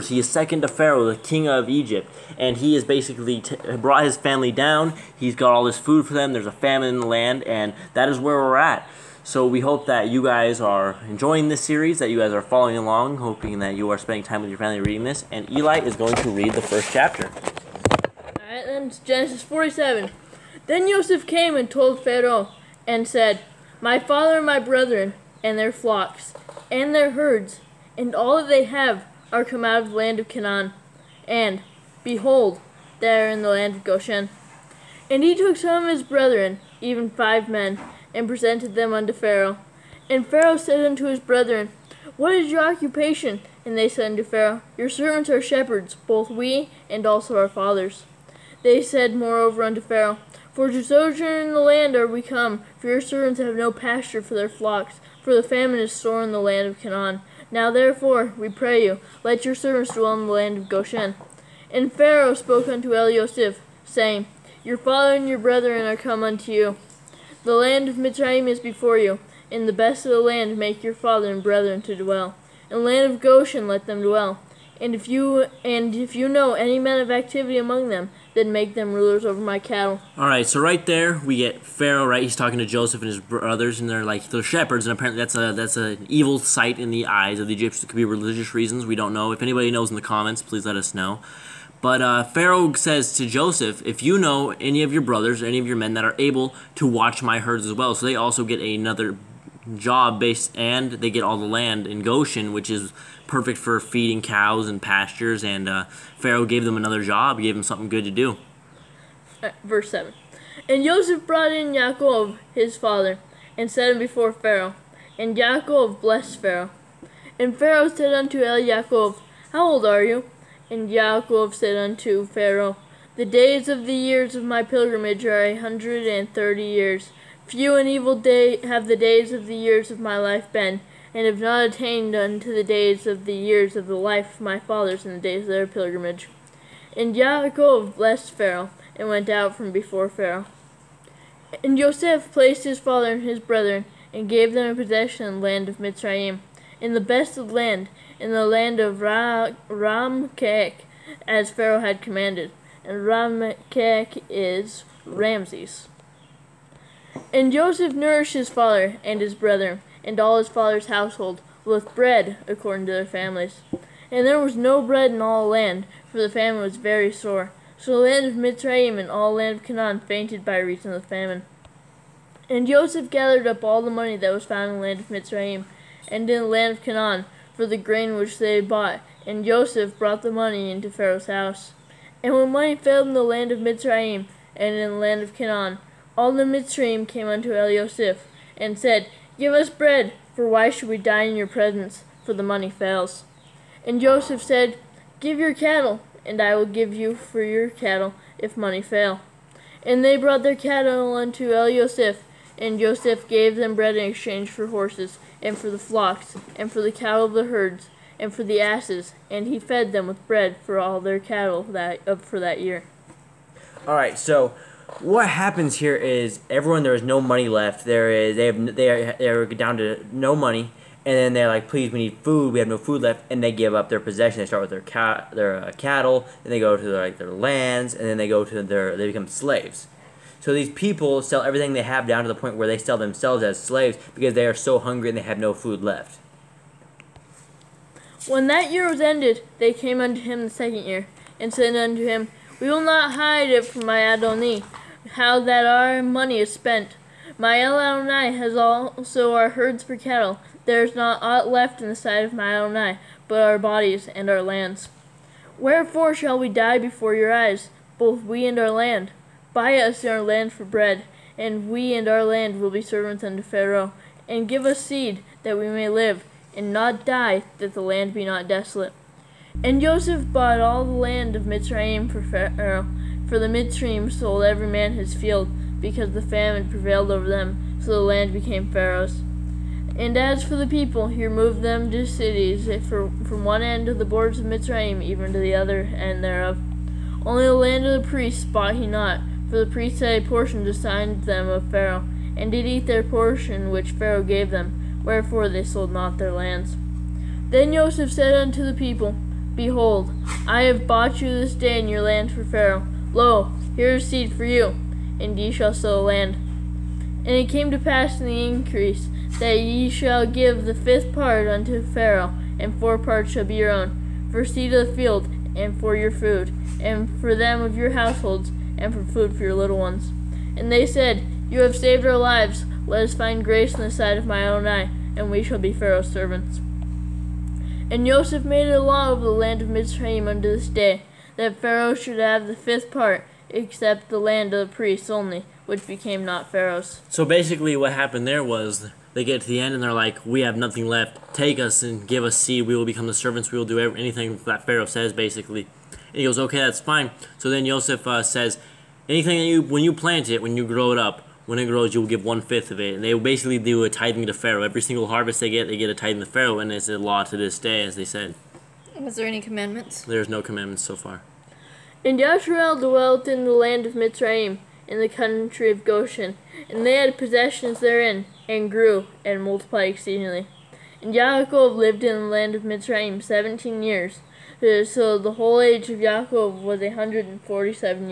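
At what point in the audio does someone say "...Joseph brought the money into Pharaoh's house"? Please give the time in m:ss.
2:59.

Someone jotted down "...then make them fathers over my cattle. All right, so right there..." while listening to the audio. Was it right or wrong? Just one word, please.
wrong.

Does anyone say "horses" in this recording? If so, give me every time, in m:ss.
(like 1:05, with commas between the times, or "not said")
3:24.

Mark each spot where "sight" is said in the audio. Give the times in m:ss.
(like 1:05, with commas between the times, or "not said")
1:26, 4:11, 5:23.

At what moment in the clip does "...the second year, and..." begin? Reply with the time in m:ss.
4:00.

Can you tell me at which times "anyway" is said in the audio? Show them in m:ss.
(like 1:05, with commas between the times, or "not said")
not said.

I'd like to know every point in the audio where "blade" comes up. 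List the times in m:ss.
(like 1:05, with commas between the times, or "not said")
not said.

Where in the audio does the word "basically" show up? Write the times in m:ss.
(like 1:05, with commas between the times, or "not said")
0:02, 5:37, 5:45, 5:53.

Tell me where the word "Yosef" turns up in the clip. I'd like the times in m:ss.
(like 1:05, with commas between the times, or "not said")
1:03, 3:07, 3:21.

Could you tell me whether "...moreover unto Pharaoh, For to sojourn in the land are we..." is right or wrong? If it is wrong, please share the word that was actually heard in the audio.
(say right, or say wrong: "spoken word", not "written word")
right.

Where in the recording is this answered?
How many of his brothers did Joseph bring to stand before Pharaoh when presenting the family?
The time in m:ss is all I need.
0:37.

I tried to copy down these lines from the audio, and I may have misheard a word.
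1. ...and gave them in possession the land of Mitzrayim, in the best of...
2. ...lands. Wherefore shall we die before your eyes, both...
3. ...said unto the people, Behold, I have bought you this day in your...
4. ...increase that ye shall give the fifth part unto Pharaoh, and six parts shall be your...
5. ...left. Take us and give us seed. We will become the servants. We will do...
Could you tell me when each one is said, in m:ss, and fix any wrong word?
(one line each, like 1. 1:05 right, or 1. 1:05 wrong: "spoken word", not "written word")
1. 2:24 right
2. 4:14 right
3. 4:58 right
4. 5:08 wrong: "four", not "six"
5. 5:40 right.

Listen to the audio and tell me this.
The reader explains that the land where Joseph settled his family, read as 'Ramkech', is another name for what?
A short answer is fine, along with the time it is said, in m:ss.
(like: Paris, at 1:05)
Ramses, at 2:35.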